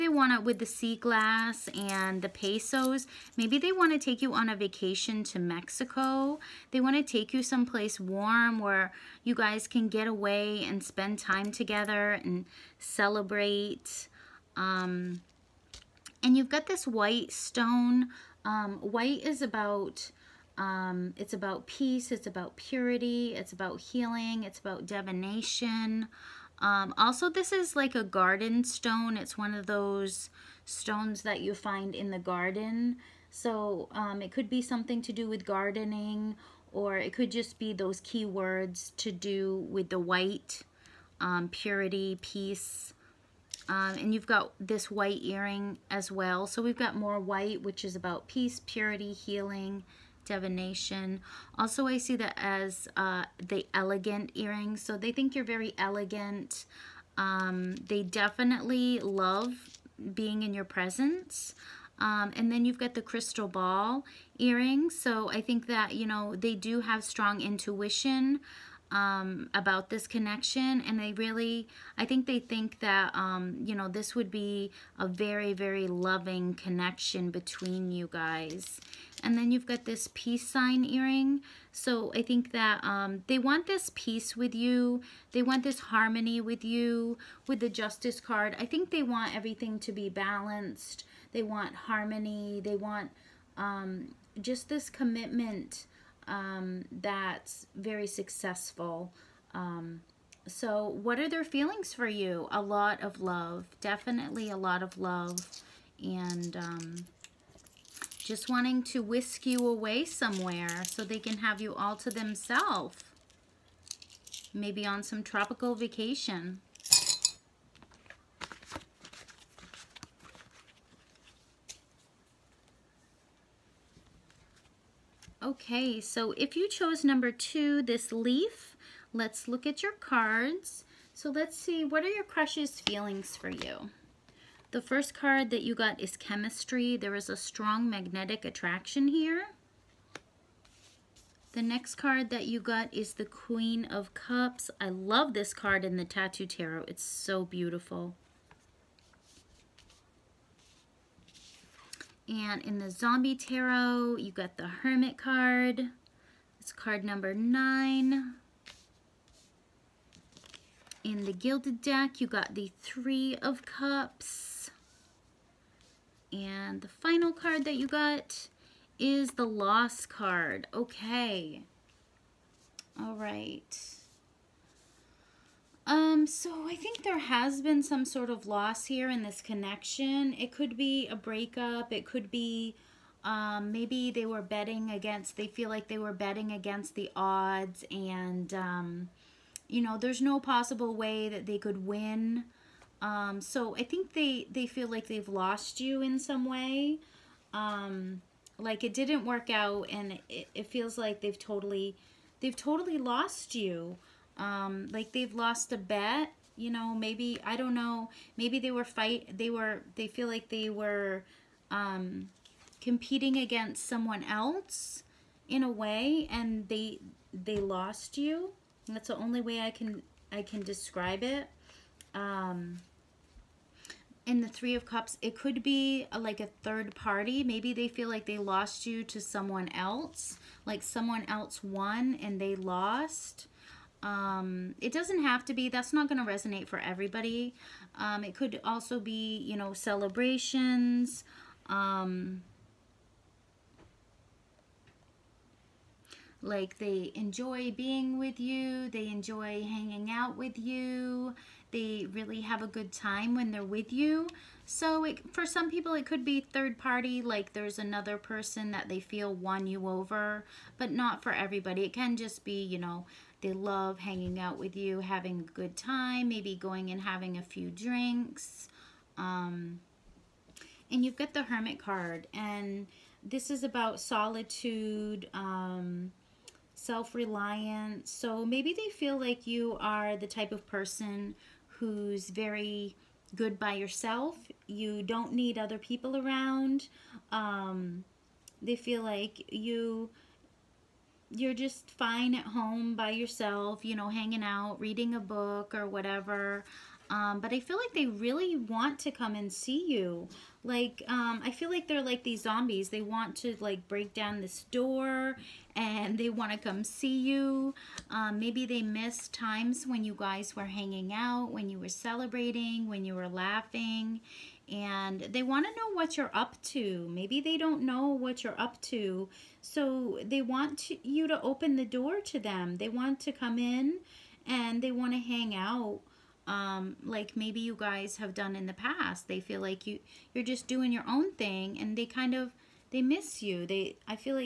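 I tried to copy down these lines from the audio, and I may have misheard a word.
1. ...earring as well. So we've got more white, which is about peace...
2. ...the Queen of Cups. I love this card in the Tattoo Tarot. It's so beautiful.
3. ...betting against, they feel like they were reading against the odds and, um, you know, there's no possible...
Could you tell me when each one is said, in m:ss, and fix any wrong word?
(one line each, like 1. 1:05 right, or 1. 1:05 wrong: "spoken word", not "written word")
1. 0:45 right
2. 2:23 right
3. 3:04 wrong: "betting", not "reading".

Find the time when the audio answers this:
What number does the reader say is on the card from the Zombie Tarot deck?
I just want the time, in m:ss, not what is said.
2:37.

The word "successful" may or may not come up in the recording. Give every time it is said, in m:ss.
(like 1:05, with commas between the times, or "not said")
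1:38.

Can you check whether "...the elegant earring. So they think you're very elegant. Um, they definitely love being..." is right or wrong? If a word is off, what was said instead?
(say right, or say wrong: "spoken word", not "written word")
right.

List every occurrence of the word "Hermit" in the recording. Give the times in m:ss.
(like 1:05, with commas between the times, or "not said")
2:34, 4:31.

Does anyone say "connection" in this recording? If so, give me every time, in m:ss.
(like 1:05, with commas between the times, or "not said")
1:10, 1:16, 2:59.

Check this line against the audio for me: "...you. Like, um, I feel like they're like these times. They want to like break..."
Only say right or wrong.
wrong.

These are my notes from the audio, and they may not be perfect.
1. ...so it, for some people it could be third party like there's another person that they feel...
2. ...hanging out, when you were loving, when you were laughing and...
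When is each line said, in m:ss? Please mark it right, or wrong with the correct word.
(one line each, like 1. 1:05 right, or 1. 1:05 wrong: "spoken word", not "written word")
1. 4:14 right
2. 5:10 wrong: "celebrating", not "loving".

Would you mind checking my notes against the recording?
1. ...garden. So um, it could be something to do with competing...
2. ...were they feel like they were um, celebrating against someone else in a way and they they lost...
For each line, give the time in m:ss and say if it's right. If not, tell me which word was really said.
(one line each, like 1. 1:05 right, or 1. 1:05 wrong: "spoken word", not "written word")
1. 0:32 wrong: "gardening", not "competing"
2. 3:29 wrong: "competing", not "celebrating".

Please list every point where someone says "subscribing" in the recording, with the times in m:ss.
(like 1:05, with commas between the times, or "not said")
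not said.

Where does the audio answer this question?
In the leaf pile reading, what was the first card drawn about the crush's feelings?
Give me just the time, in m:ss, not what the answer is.
2:16.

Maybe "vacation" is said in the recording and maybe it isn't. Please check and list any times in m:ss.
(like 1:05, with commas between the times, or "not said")
0:04, 1:55.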